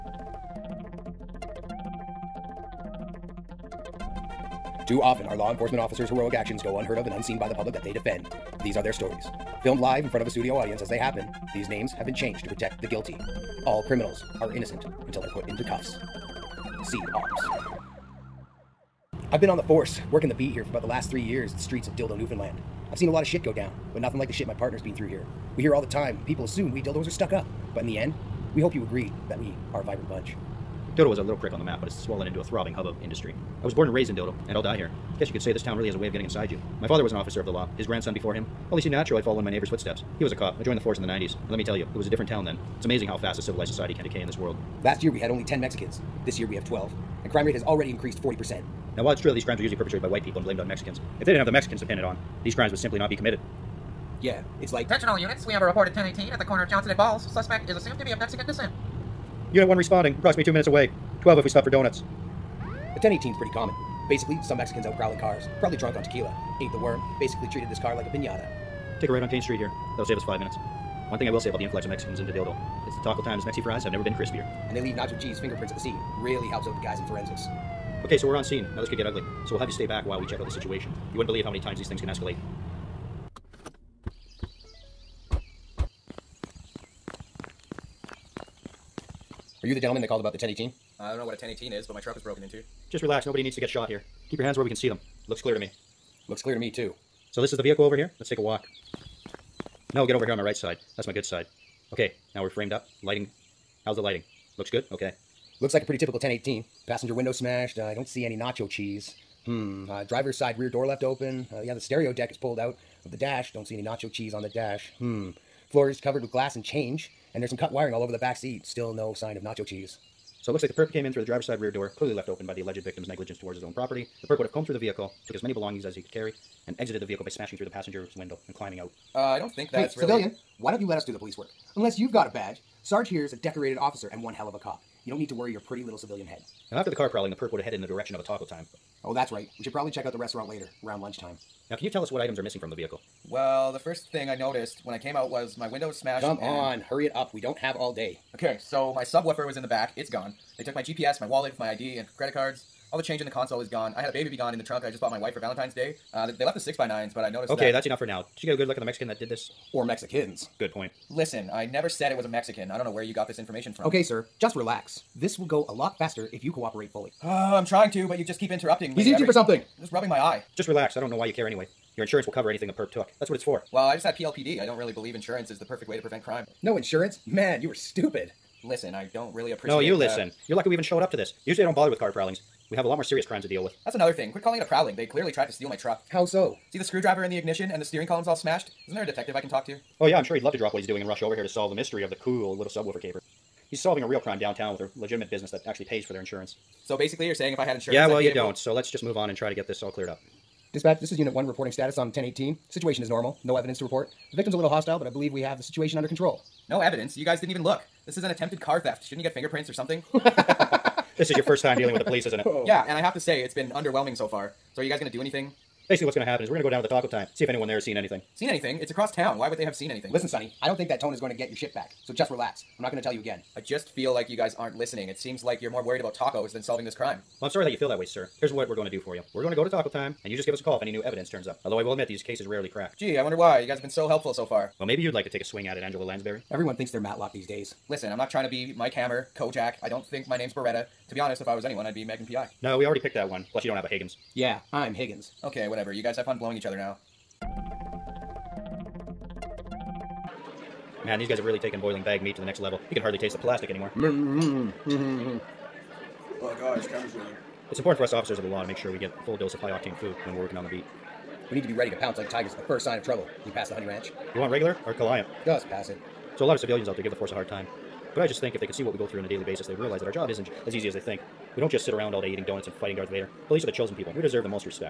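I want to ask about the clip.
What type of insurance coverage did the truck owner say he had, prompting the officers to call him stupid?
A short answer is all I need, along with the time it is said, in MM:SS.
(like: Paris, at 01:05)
PLPD, at 02:54.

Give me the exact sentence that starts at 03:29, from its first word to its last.
Shouldn't you get fingerprints or something?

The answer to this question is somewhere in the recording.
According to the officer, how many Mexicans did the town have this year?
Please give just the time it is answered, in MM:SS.
00:46.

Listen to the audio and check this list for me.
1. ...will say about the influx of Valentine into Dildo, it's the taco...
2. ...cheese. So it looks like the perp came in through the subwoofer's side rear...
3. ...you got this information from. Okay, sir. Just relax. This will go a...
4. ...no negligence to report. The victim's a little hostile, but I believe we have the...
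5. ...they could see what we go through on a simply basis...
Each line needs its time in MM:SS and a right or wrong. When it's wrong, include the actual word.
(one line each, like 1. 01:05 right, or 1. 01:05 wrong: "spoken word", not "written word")
1. 01:11 wrong: "Mexicans", not "Valentine"
2. 01:59 wrong: "driver", not "subwoofer"
3. 02:43 right
4. 03:23 wrong: "evidence", not "negligence"
5. 04:28 wrong: "daily", not "simply".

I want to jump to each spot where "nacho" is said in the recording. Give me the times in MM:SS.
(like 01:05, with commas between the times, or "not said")
01:14, 01:48, 01:53, 01:59.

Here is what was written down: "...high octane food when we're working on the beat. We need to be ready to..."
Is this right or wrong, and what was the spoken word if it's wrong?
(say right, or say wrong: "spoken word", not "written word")
right.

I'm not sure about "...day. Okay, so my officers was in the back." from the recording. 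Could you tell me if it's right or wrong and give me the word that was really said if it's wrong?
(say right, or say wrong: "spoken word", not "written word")
wrong: "subwoofer", not "officers".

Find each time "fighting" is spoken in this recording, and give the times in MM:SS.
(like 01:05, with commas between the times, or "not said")
04:32.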